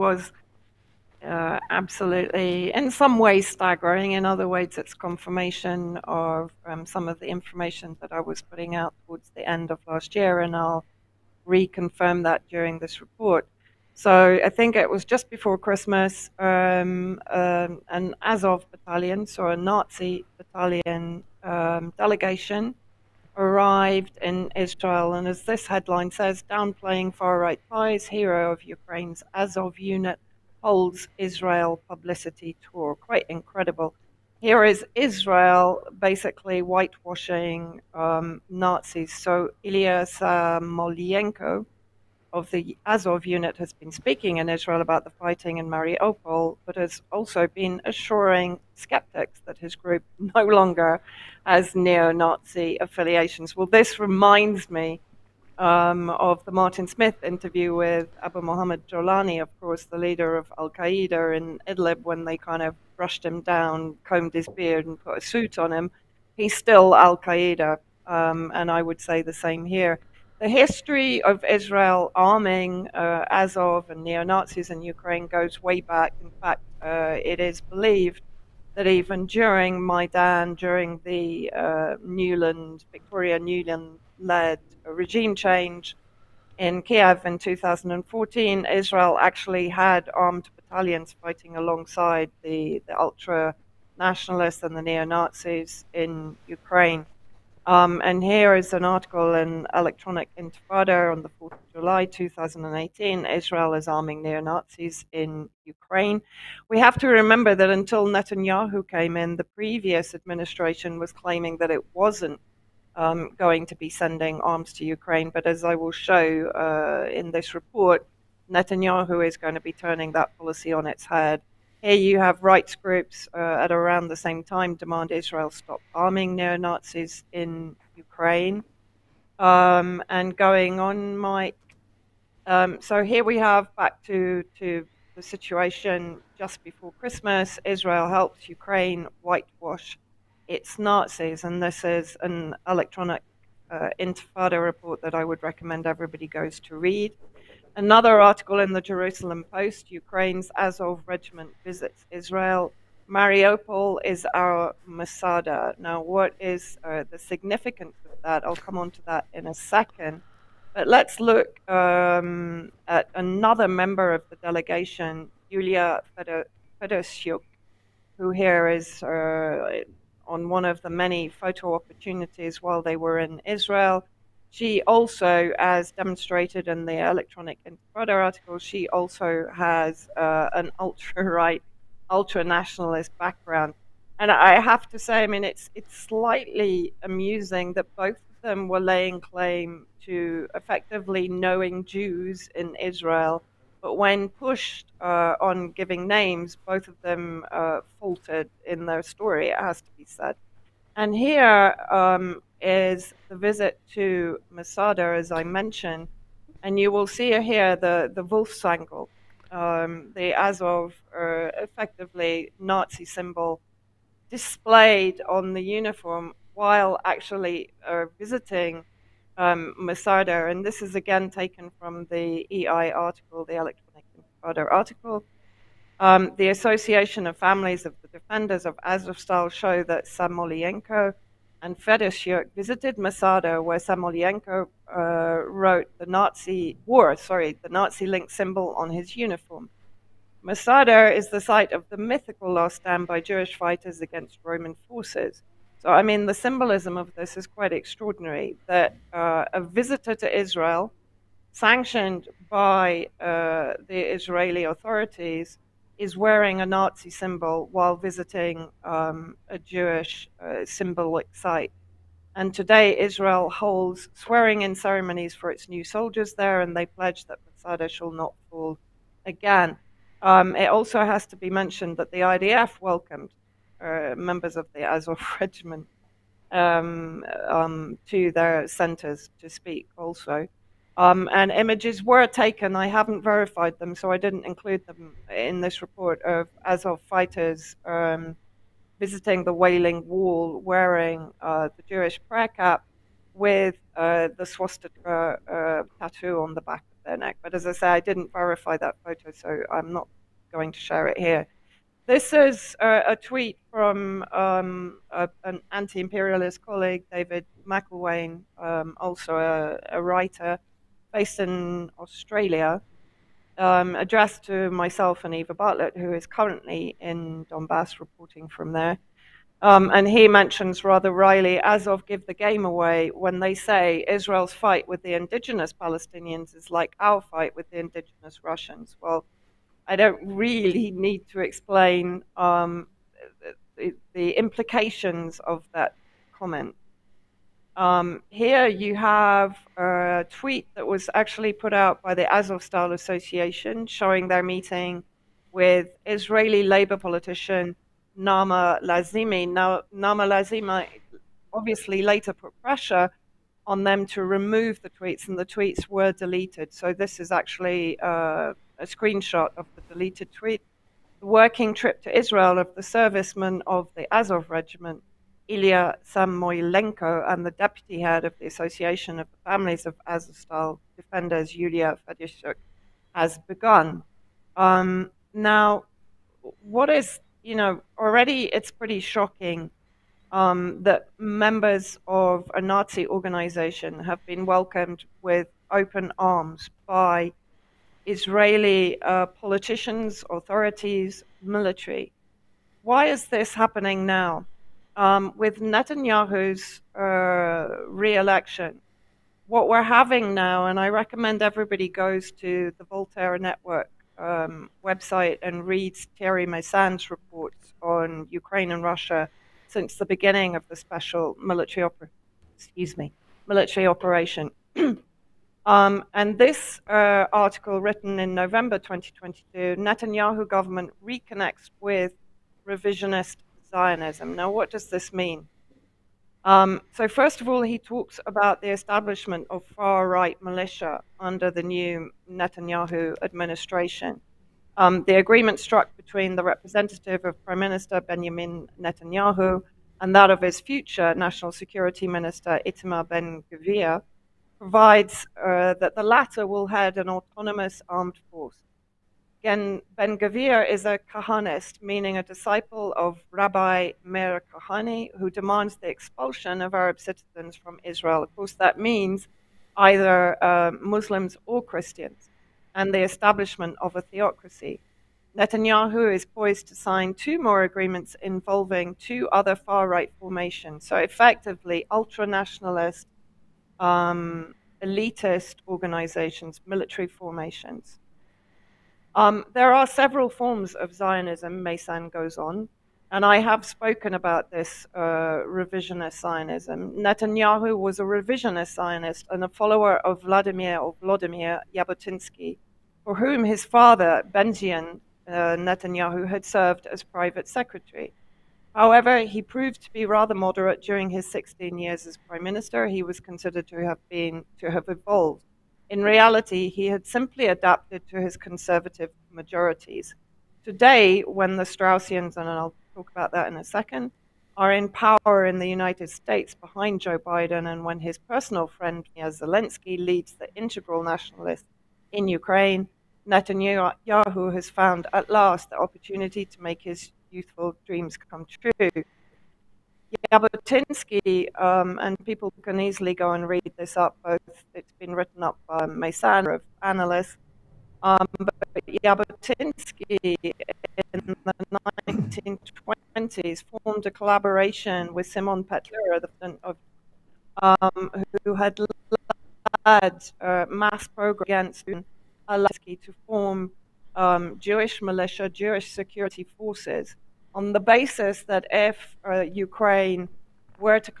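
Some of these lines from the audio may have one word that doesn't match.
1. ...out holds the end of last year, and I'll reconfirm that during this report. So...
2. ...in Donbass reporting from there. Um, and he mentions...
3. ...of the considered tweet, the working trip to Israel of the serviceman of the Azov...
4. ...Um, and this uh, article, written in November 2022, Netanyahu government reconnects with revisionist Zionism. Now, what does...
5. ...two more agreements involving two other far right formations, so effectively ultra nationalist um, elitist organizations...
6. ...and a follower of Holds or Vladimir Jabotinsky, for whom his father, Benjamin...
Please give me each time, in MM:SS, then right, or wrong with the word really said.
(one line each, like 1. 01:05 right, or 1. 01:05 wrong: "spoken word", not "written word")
1. 00:08 wrong: "towards", not "holds"
2. 05:16 right
3. 05:59 wrong: "deleted", not "considered"
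4. 06:55 right
5. 07:47 right
6. 08:09 wrong: "Vladimir", not "Holds".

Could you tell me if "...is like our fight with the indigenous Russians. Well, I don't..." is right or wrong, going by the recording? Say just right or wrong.
right.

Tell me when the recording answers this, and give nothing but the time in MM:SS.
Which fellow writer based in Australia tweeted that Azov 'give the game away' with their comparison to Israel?
05:07.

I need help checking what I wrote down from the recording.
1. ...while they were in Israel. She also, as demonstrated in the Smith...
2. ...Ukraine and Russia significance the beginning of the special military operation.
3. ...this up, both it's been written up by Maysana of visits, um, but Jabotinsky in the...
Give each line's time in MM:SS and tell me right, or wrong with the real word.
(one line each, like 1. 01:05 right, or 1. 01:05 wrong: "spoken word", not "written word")
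1. 02:52 wrong: "Electronic", not "Smith"
2. 06:48 wrong: "since", not "significance"
3. 08:53 wrong: "analysts", not "visits".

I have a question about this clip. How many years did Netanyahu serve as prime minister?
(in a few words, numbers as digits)
16.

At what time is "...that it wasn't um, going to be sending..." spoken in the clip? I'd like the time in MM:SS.
01:51.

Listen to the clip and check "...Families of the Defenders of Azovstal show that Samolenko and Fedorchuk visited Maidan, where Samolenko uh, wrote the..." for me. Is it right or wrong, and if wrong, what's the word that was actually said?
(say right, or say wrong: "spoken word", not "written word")
wrong: "Masada", not "Maidan".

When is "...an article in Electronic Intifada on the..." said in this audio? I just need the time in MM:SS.
01:38.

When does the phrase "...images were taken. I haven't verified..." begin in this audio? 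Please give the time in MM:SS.
04:41.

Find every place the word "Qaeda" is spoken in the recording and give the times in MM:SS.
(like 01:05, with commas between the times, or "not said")
01:00, 01:07.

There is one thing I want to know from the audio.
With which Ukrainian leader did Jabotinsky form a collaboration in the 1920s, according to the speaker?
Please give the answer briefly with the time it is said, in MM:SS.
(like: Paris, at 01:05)
Simon Petlura, at 09:05.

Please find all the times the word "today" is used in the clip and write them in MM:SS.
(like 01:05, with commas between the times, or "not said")
04:22, 08:30.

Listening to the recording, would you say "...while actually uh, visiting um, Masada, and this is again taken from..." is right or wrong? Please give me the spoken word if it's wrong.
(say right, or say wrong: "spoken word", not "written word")
right.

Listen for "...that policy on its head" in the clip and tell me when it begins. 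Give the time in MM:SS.
02:00.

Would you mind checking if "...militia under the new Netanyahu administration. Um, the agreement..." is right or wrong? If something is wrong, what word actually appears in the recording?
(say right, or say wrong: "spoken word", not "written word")
right.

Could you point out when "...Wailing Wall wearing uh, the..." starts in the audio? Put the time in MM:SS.
04:49.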